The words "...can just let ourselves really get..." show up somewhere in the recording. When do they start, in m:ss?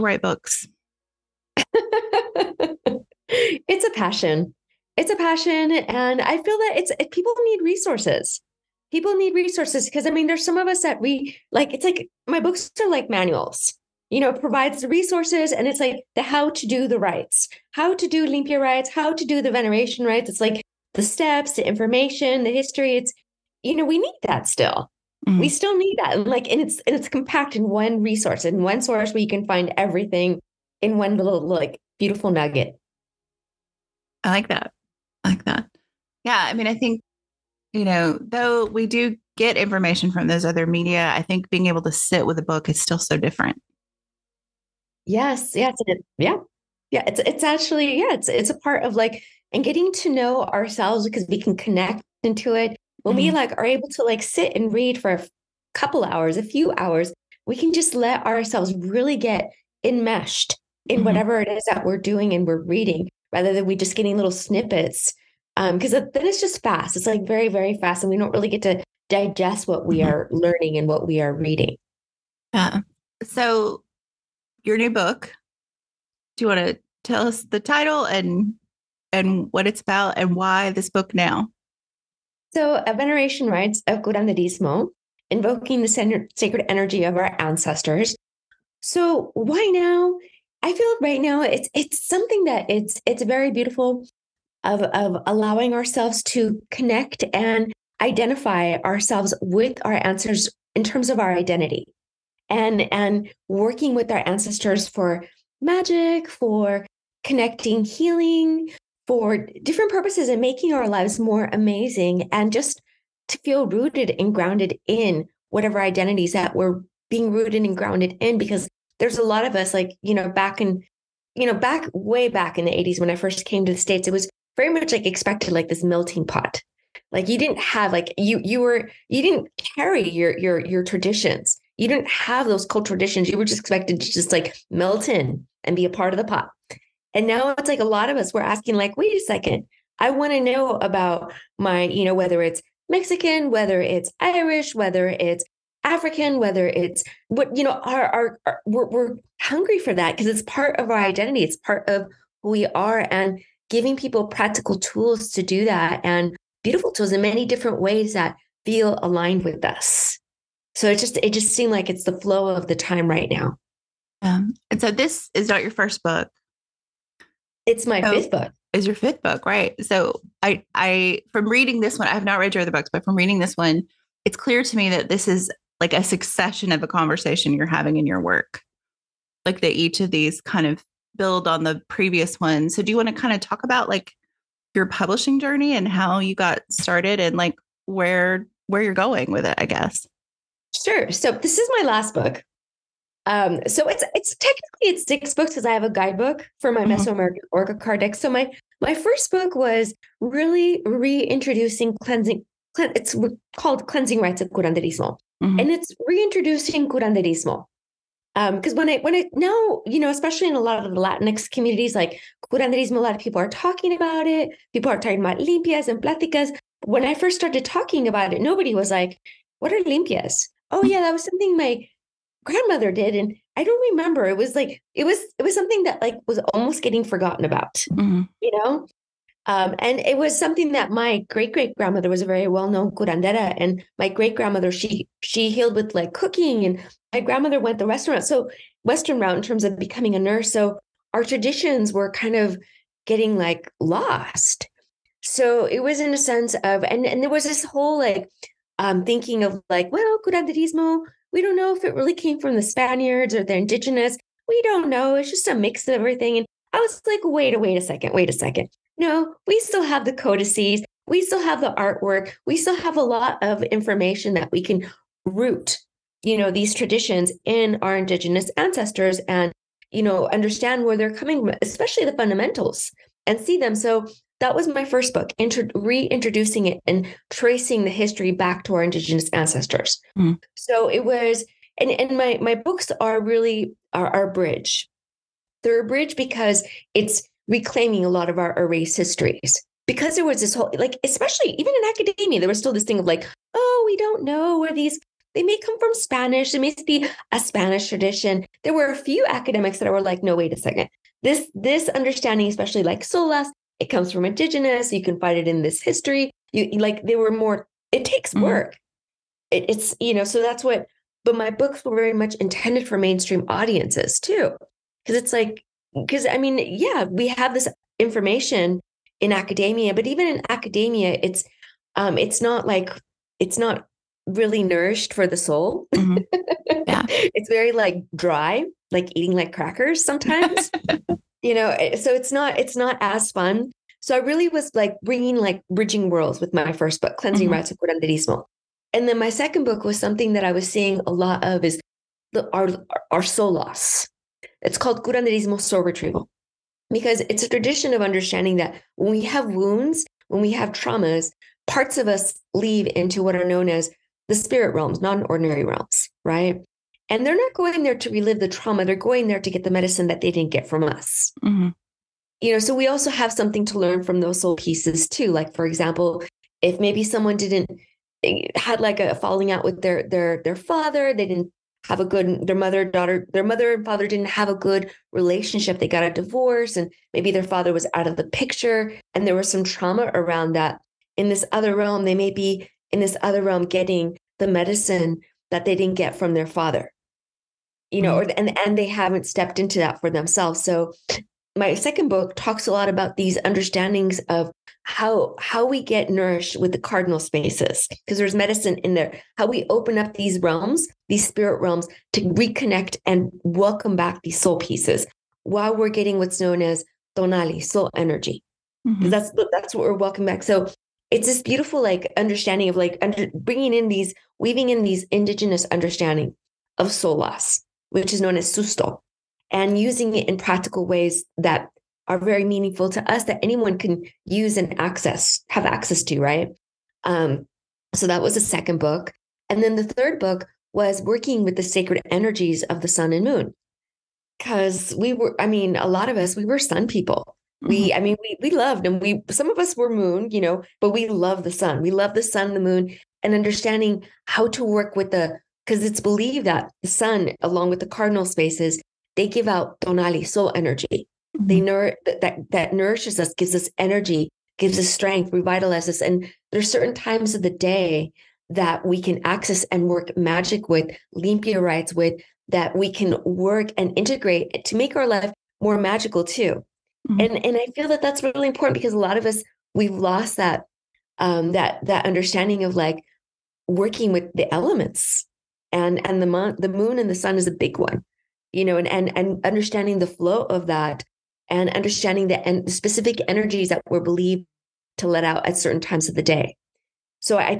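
0:57.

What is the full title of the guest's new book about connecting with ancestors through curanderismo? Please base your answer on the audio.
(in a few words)
Veneration Rites of Curanderismo.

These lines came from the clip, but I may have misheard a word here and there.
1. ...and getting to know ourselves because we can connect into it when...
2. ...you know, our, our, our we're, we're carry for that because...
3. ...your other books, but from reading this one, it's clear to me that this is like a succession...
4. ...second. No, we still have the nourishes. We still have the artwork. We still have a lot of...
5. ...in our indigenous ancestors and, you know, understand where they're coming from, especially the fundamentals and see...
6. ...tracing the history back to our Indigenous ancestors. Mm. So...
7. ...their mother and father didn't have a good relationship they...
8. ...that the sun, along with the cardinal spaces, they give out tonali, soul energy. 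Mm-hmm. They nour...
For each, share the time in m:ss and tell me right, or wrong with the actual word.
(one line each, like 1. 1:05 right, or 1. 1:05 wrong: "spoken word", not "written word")
1. 0:49 right
2. 2:27 wrong: "hungry", not "carry"
3. 2:52 right
4. 4:18 wrong: "codices", not "nourishes"
5. 4:27 right
6. 4:37 right
7. 6:13 right
8. 7:26 right.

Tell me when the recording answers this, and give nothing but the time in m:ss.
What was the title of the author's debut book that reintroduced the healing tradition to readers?
3:23.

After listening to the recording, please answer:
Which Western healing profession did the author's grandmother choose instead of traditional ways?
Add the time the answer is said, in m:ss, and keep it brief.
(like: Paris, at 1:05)
nurse, at 4:00.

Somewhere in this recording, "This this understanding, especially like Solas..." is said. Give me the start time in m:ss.
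5:01.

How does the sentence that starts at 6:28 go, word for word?
and and they haven't stepped into that for themselves.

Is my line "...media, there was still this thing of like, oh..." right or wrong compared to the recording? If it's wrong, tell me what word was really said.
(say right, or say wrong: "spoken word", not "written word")
wrong: "academia", not "media".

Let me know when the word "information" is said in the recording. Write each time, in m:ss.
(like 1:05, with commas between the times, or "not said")
0:21, 0:39, 4:23, 5:17.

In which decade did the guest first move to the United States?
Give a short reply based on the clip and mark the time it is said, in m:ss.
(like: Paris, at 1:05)
the 80s, at 2:02.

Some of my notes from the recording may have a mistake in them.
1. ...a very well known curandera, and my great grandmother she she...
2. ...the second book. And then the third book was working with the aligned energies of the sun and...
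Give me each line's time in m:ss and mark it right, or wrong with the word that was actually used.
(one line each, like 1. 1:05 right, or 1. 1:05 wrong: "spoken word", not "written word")
1. 3:52 right
2. 7:08 wrong: "sacred", not "aligned".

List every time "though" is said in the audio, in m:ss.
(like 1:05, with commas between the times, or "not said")
0:38.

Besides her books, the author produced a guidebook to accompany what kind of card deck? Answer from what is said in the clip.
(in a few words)
Mesoamerican Oracle card deck.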